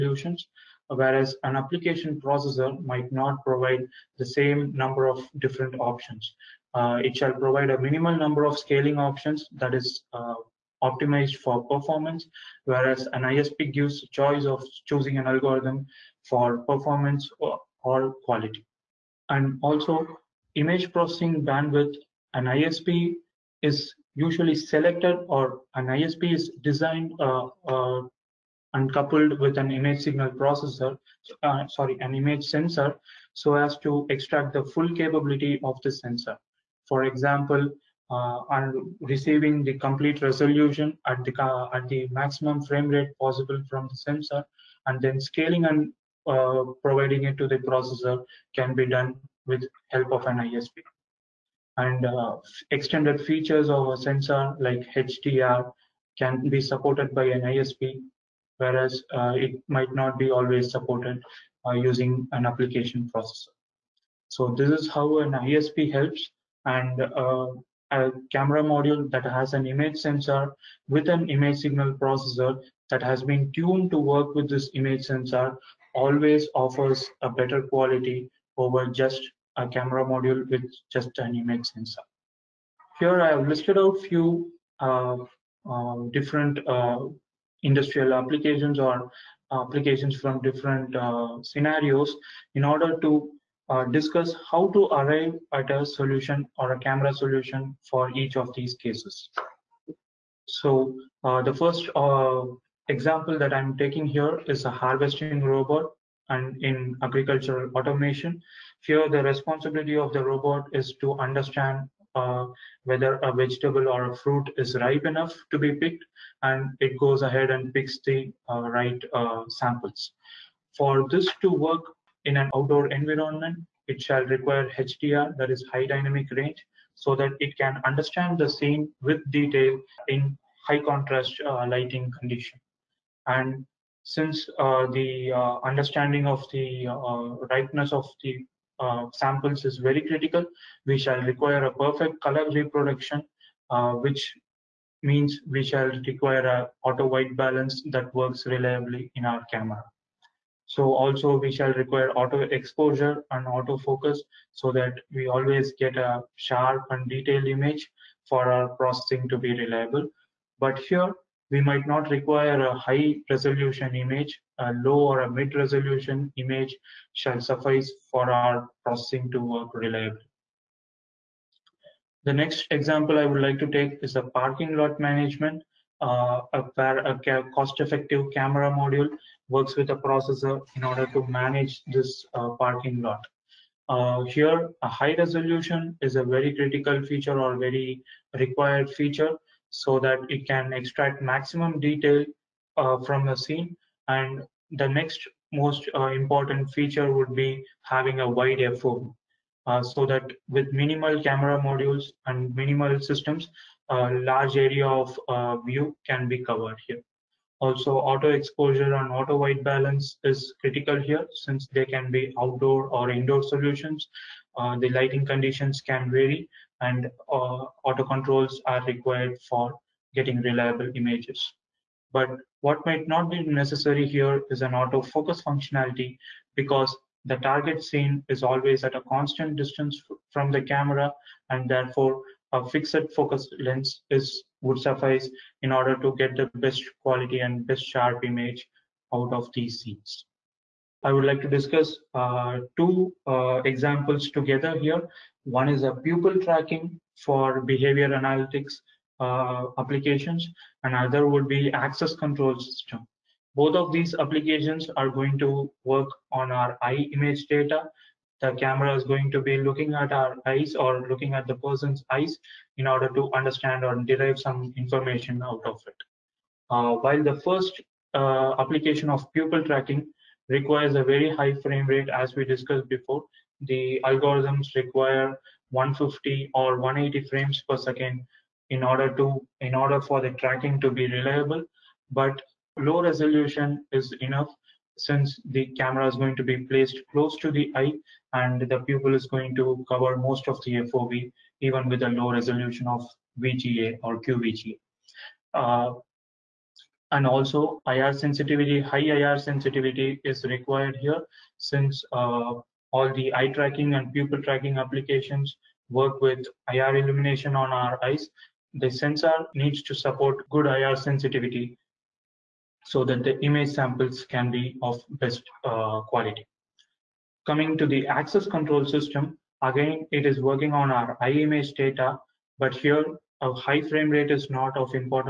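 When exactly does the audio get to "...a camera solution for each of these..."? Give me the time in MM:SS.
01:36.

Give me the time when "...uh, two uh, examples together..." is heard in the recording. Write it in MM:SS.
04:02.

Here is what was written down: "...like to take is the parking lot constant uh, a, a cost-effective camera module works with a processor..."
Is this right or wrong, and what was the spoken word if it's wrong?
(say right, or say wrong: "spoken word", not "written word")
wrong: "management", not "constant".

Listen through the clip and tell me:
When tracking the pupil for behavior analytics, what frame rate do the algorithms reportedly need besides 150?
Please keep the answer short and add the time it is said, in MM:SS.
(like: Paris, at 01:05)
180 frames per second, at 04:36.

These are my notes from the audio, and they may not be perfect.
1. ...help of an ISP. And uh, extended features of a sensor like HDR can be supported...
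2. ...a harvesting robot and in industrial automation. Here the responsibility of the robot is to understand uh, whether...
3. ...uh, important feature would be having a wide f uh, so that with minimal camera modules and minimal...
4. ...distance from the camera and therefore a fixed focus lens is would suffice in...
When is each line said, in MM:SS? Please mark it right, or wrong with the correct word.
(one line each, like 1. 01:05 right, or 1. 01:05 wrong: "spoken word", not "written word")
1. 00:49 right
2. 01:44 wrong: "agricultural", not "industrial"
3. 03:15 right
4. 03:49 right.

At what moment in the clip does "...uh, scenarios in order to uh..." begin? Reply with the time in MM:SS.
01:30.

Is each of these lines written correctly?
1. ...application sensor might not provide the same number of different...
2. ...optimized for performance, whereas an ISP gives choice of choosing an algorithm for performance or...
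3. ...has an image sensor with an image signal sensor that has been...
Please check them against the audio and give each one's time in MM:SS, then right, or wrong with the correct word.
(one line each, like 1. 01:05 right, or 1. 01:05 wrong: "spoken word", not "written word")
1. 00:01 wrong: "processor", not "sensor"
2. 00:10 right
3. 01:09 wrong: "processor", not "sensor".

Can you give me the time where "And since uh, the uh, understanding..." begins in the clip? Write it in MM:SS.
02:13.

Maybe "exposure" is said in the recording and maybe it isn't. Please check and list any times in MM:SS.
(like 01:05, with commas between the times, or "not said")
02:32, 03:28.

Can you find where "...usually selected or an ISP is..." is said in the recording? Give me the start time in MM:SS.
00:24.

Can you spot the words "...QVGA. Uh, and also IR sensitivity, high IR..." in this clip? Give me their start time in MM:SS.
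04:54.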